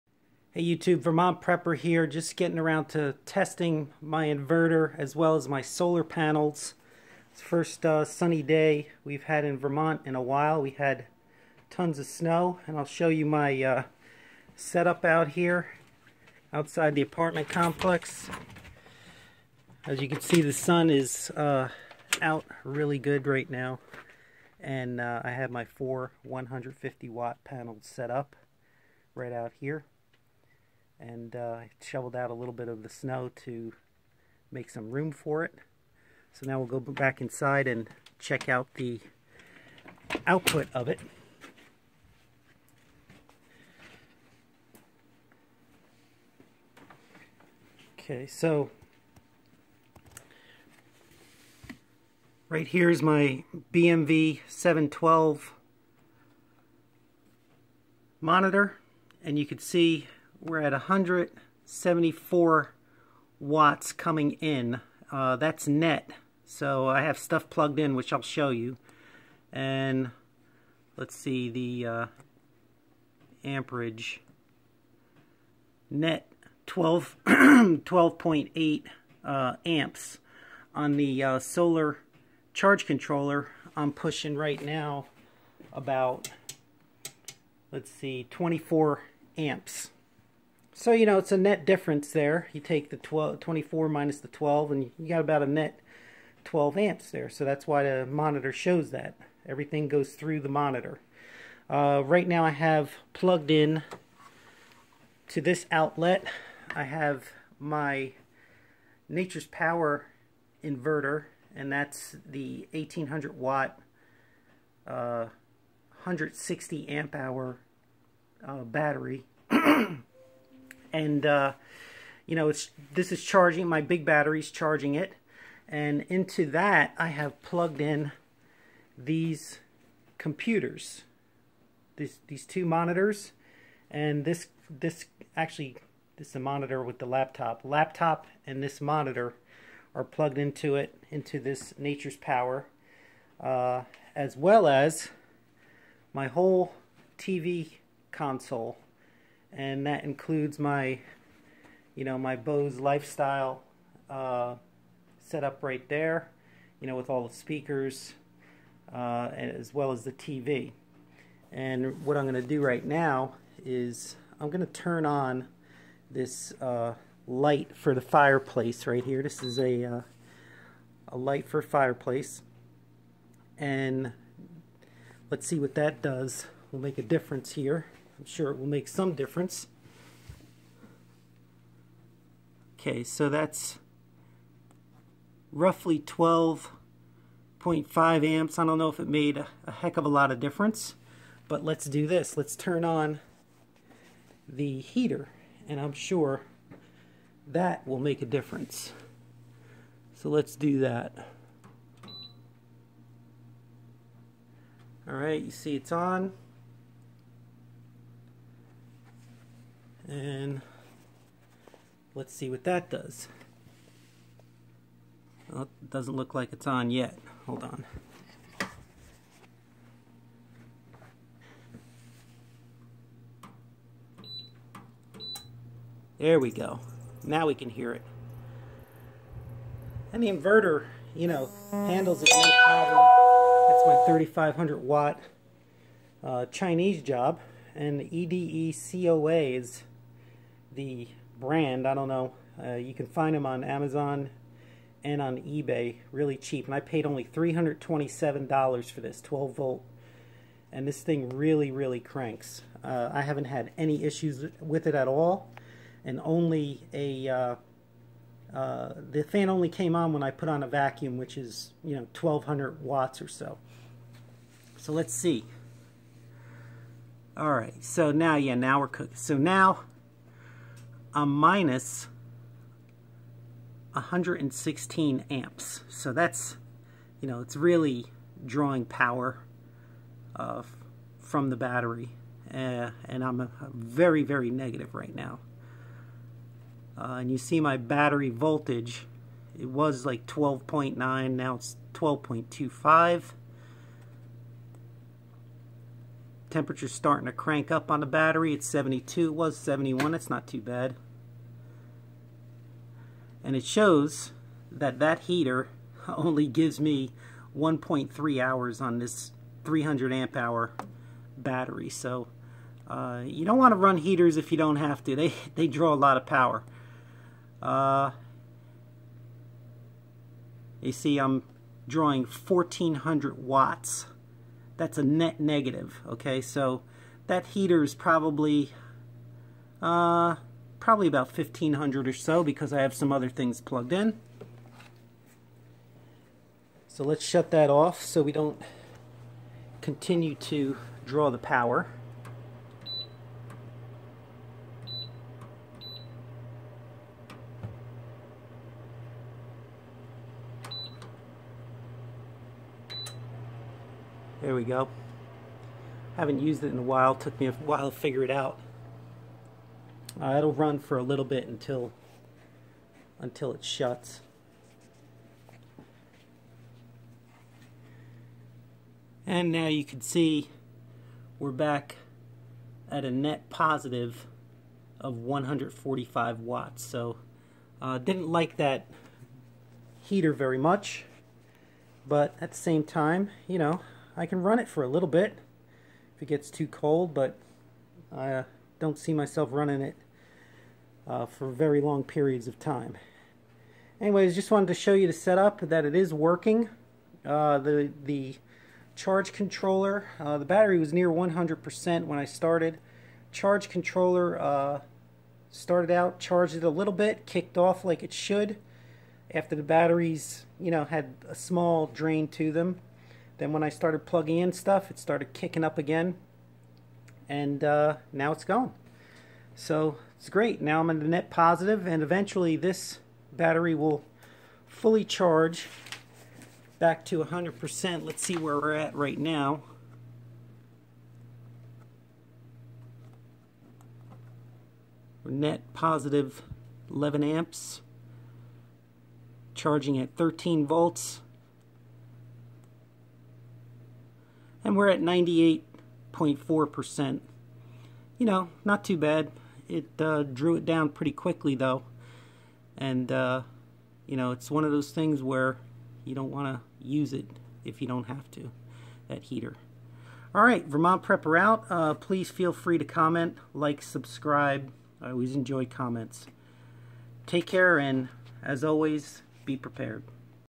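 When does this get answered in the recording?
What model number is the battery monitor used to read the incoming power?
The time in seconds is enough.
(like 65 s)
53 s.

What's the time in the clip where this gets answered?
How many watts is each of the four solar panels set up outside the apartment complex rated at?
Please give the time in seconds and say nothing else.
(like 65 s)
26 s.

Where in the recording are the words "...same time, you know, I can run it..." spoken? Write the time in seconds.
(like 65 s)
382 s.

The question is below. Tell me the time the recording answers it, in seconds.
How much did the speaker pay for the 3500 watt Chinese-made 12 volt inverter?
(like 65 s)
247 s.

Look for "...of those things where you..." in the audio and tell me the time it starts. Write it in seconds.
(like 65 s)
454 s.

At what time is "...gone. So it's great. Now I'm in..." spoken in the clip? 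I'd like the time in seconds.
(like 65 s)
418 s.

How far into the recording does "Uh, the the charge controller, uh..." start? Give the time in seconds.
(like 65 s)
397 s.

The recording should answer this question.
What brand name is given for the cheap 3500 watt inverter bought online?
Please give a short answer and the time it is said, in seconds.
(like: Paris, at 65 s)
EDE COA, at 238 s.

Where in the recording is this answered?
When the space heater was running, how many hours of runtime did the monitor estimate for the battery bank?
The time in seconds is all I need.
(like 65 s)
307 s.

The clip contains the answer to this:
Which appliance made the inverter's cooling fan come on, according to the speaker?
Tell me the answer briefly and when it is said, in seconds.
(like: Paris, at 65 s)
A vacuum, at 260 s.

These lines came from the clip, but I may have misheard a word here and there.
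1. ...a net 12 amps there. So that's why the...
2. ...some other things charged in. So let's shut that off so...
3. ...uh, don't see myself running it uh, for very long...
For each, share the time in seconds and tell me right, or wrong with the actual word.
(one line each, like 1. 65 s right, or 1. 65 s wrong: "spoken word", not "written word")
1. 95 s right
2. 332 s wrong: "plugged", not "charged"
3. 388 s right.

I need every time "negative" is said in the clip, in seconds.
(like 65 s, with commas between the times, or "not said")
284 s, 325 s.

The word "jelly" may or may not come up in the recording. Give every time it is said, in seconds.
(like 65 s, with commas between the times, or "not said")
not said.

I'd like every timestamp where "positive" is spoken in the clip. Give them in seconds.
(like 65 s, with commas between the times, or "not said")
373 s, 421 s, 435 s.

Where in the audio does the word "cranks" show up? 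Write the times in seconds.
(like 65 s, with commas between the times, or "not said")
251 s, 297 s.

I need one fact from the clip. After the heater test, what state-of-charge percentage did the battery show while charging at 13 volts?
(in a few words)
98.4%.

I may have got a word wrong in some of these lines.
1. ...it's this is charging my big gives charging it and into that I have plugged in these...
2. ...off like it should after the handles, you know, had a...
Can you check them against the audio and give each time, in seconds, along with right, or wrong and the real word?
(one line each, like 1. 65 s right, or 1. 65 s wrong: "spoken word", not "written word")
1. 122 s wrong: "batteries", not "gives"
2. 407 s wrong: "batteries", not "handles".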